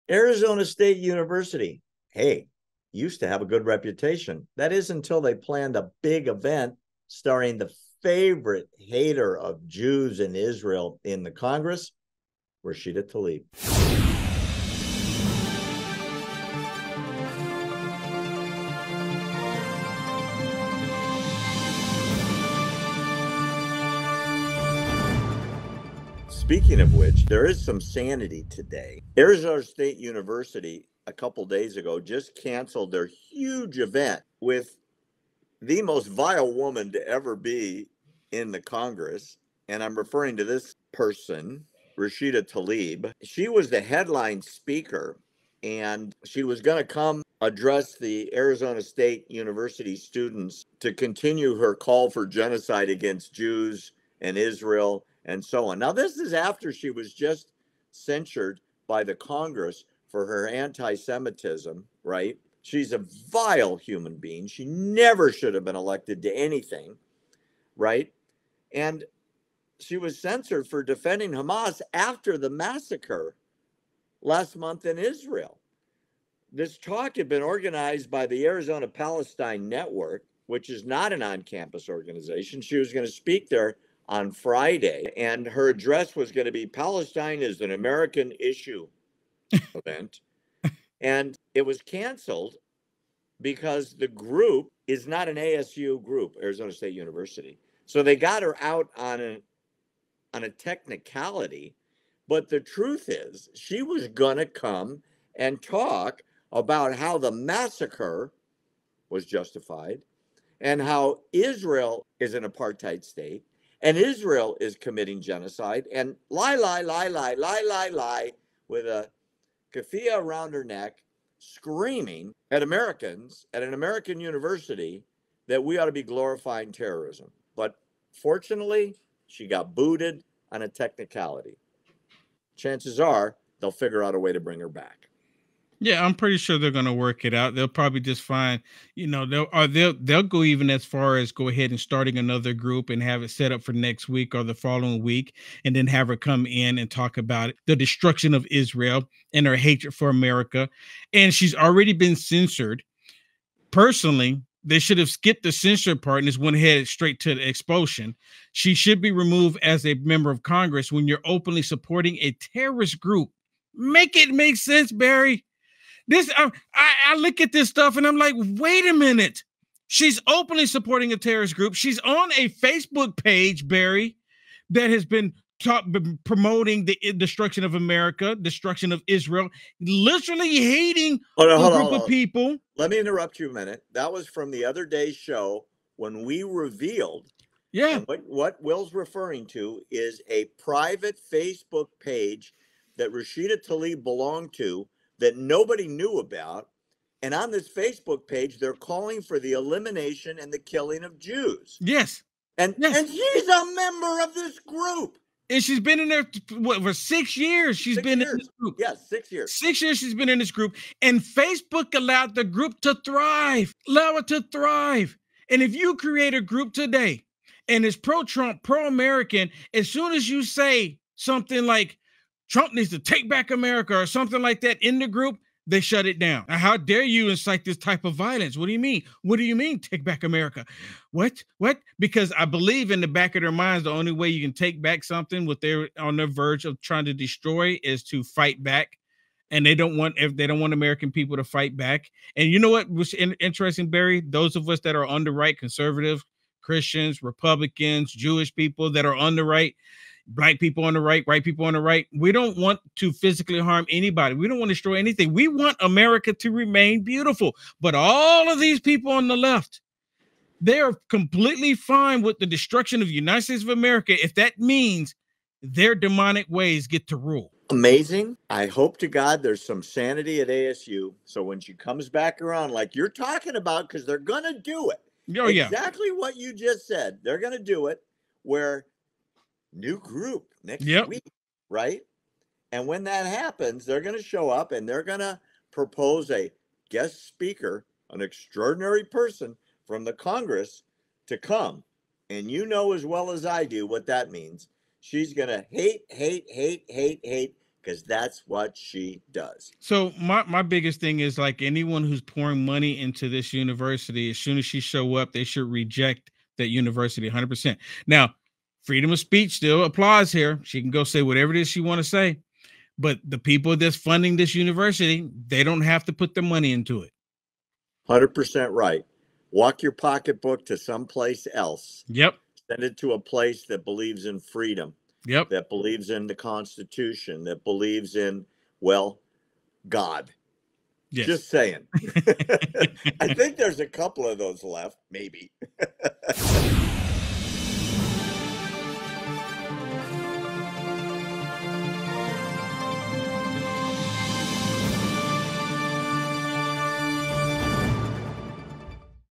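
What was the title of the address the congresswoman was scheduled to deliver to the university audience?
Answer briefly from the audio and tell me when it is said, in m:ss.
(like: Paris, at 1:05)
Palestine is an American issue, at 1:26.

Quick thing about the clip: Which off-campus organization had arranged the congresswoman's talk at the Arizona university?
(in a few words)
Arizona Palestine Network.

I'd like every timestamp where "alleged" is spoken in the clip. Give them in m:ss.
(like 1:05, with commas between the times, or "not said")
not said.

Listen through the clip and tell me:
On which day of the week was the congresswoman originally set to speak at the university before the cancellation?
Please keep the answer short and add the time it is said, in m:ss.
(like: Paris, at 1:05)
Friday, at 1:24.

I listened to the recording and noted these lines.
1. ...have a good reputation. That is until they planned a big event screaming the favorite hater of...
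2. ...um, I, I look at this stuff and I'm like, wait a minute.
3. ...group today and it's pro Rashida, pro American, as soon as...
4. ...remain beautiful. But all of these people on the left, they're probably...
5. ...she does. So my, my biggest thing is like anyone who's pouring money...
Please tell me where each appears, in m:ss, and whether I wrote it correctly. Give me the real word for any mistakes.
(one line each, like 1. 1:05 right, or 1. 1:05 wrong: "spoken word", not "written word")
1. 0:03 wrong: "starring", not "screaming"
2. 2:46 right
3. 3:36 wrong: "Trump", not "Rashida"
4. 4:16 wrong: "completely", not "probably"
5. 4:58 right.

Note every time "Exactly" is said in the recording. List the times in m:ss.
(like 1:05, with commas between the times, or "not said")
4:35.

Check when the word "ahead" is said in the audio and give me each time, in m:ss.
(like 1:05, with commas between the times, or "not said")
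2:21, 2:36.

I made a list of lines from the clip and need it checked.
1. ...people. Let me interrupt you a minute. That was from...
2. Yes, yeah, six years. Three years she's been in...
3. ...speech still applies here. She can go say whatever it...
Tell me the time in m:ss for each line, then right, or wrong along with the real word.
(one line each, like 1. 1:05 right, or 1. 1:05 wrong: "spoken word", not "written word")
1. 3:02 right
2. 3:28 wrong: "Six", not "Three"
3. 5:09 right.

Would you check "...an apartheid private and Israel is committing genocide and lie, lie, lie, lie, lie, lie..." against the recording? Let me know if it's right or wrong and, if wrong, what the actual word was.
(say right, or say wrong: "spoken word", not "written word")
wrong: "state", not "private".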